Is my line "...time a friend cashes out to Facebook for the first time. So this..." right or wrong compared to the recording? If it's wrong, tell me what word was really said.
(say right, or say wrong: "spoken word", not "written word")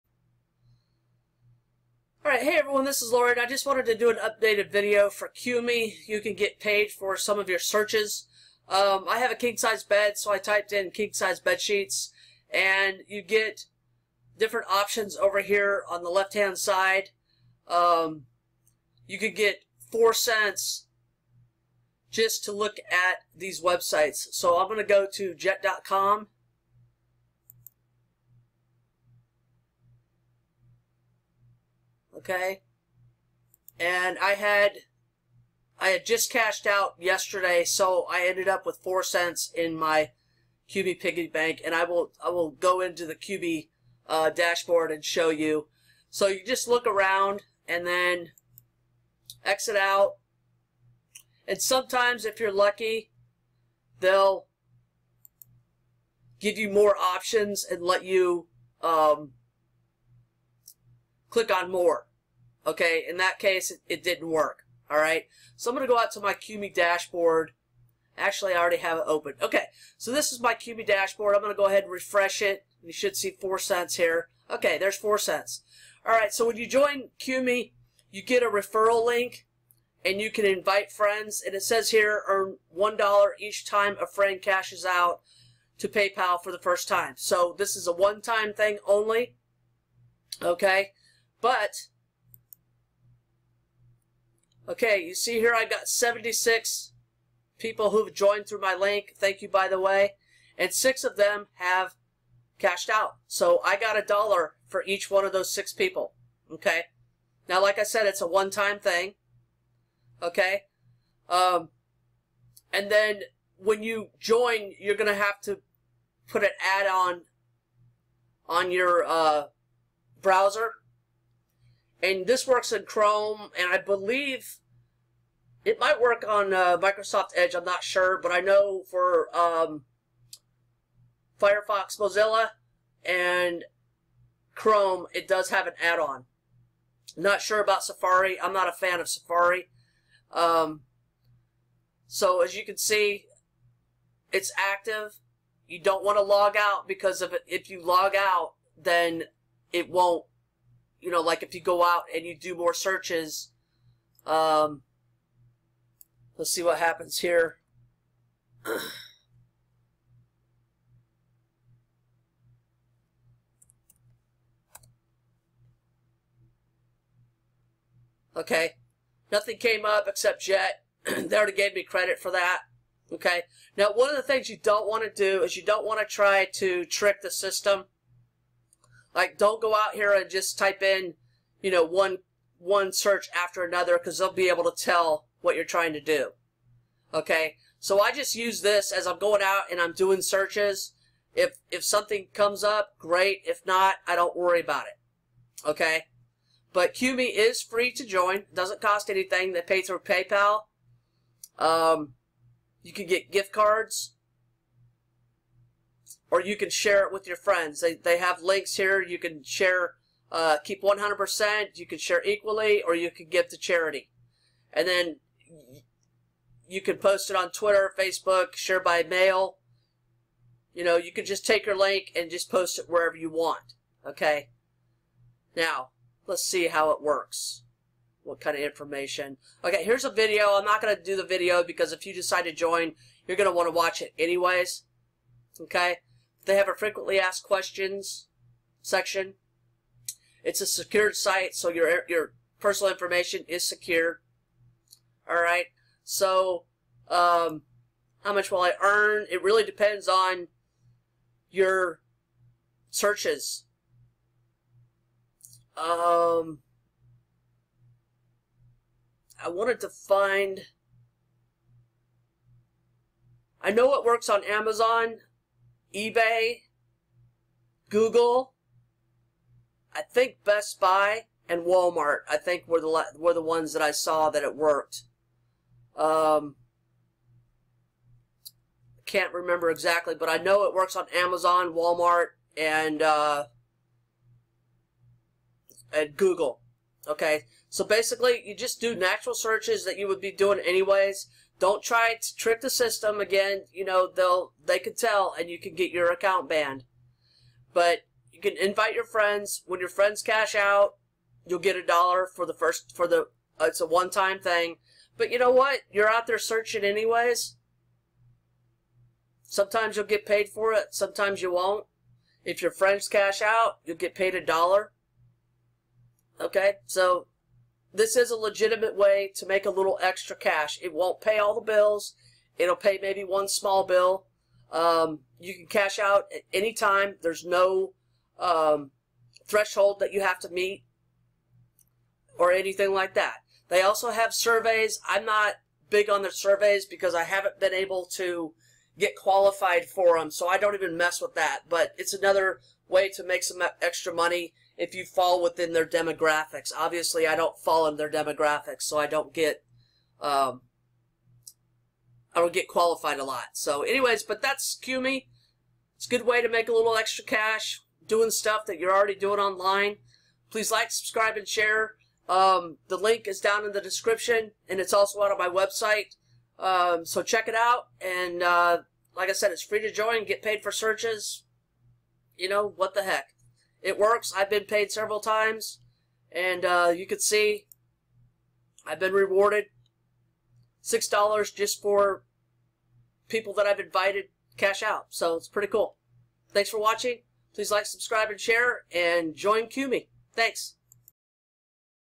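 wrong: "PayPal", not "Facebook".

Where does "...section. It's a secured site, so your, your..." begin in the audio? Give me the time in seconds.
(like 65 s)
238 s.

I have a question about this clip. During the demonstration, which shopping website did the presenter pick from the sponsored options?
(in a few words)
jet.com.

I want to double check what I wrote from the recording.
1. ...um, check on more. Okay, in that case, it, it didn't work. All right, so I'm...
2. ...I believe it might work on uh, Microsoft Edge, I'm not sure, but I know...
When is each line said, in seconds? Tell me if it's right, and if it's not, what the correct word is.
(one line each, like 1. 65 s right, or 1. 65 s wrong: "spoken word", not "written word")
1. 58 s wrong: "click", not "check"
2. 123 s right.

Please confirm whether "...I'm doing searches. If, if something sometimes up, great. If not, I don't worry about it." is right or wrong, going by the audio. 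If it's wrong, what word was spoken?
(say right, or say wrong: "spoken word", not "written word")
wrong: "comes", not "sometimes".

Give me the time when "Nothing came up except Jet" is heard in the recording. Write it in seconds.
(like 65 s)
169 s.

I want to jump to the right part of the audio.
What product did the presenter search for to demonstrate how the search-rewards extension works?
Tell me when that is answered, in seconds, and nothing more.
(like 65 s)
10 s.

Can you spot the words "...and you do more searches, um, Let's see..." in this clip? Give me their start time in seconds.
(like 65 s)
152 s.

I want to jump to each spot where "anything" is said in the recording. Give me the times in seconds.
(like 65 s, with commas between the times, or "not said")
199 s, 332 s.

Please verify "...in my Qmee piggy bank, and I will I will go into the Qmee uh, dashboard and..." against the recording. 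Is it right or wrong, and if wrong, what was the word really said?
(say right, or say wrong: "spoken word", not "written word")
right.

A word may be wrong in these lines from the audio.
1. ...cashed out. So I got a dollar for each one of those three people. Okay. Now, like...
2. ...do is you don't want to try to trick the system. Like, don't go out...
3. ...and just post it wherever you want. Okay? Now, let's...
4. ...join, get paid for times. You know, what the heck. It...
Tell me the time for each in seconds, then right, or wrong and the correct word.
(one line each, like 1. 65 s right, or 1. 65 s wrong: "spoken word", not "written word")
1. 102 s wrong: "six", not "three"
2. 175 s right
3. 222 s right
4. 369 s wrong: "searches", not "times".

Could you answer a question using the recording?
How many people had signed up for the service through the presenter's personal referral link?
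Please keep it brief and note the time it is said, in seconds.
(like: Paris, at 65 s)
76, at 95 s.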